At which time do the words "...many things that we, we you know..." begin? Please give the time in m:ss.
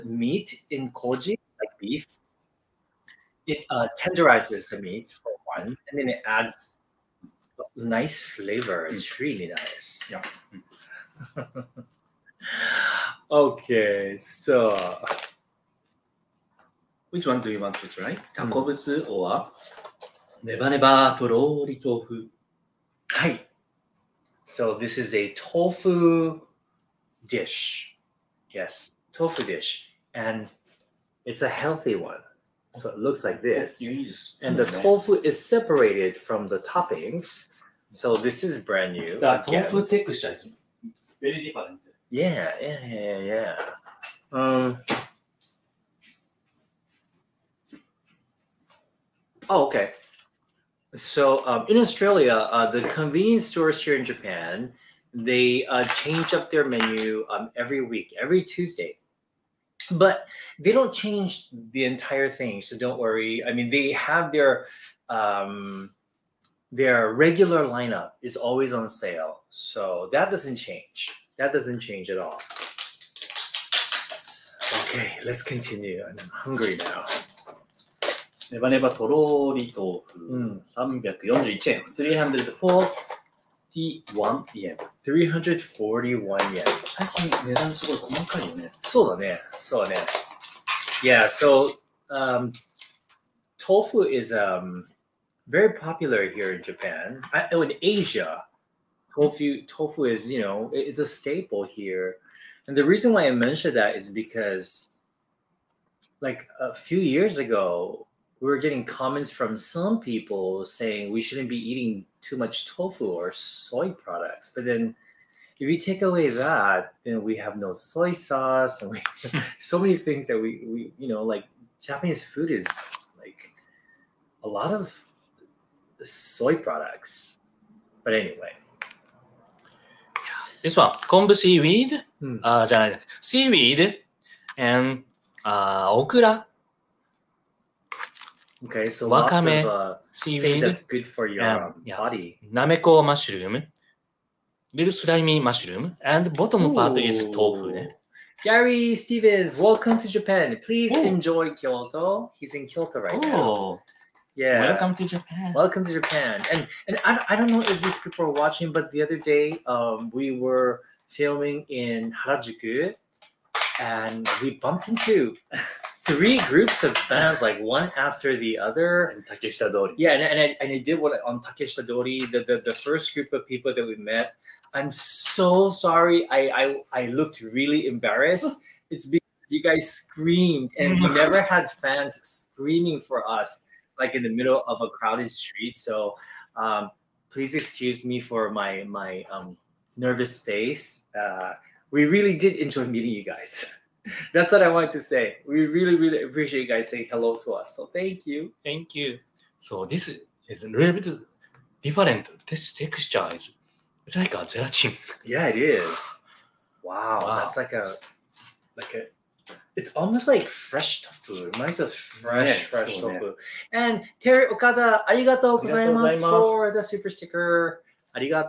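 1:59.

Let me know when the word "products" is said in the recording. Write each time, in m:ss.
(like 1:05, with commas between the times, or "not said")
1:53, 2:06.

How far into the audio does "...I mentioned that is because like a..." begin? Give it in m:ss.
1:43.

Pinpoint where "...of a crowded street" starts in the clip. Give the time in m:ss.
3:04.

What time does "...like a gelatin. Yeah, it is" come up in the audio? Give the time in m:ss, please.
3:24.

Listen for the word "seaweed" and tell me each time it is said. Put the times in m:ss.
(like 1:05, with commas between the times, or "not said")
2:11, 2:20.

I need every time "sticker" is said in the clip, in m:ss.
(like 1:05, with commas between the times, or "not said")
3:37.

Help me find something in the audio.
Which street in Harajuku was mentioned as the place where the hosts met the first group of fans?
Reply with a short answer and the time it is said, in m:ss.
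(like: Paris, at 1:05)
Takeshita Dori, at 2:51.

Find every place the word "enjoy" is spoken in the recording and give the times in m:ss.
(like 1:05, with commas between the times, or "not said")
2:31, 3:12.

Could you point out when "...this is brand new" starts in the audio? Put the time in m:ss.
0:38.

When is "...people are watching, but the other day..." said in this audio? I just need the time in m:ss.
2:38.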